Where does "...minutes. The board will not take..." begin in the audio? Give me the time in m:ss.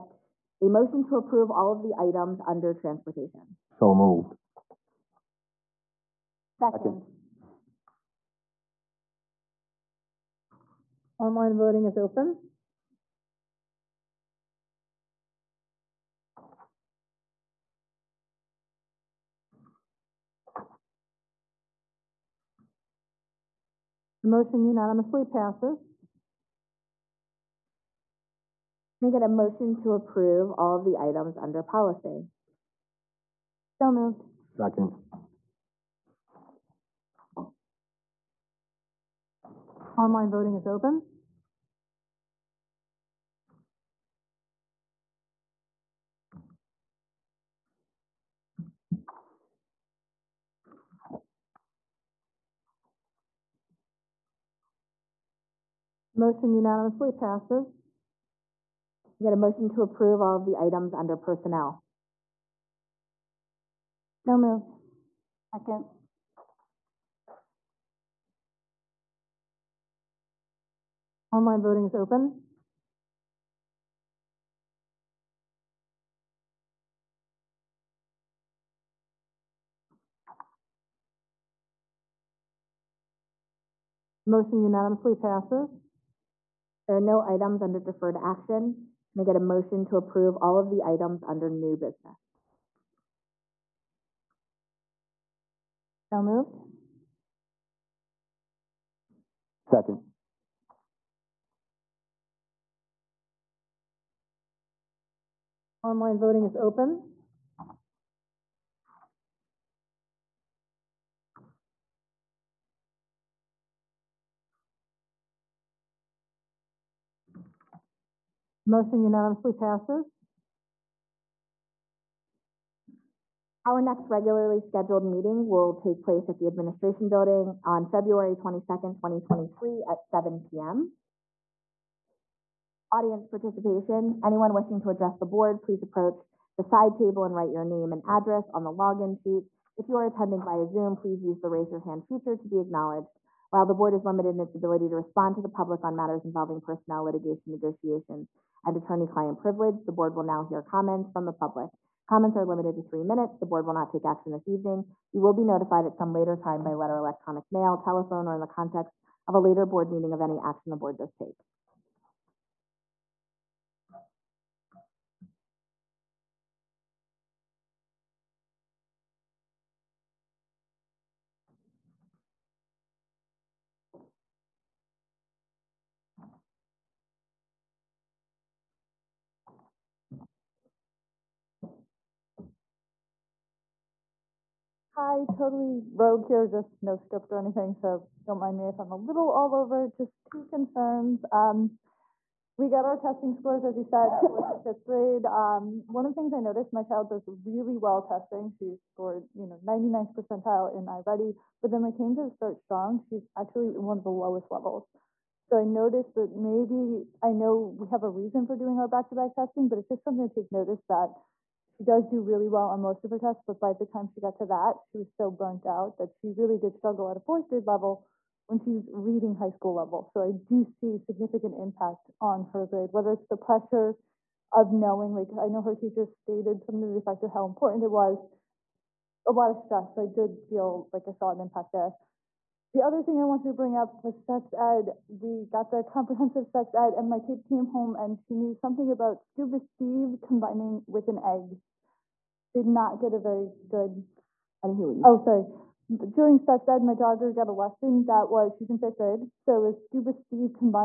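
2:33.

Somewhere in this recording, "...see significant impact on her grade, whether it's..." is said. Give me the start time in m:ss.
3:40.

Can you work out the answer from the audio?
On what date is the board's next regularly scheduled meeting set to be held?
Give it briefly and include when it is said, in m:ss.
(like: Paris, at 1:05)
February 22nd, 2023, at 2:07.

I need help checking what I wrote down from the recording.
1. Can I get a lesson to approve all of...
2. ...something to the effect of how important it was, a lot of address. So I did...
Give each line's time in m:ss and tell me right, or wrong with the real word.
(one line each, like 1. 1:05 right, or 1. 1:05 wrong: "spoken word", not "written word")
1. 0:28 wrong: "motion", not "lesson"
2. 3:46 wrong: "stress", not "address".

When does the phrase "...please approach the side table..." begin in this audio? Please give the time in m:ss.
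2:15.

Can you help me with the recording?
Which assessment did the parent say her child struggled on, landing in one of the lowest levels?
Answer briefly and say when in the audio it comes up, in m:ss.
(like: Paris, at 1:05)
Start Strong, at 3:22.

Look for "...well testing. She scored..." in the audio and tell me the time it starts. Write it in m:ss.
3:17.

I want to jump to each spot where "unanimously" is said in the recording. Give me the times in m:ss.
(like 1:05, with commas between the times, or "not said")
0:24, 0:56, 1:24, 1:58.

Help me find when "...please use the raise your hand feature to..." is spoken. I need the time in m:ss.
2:20.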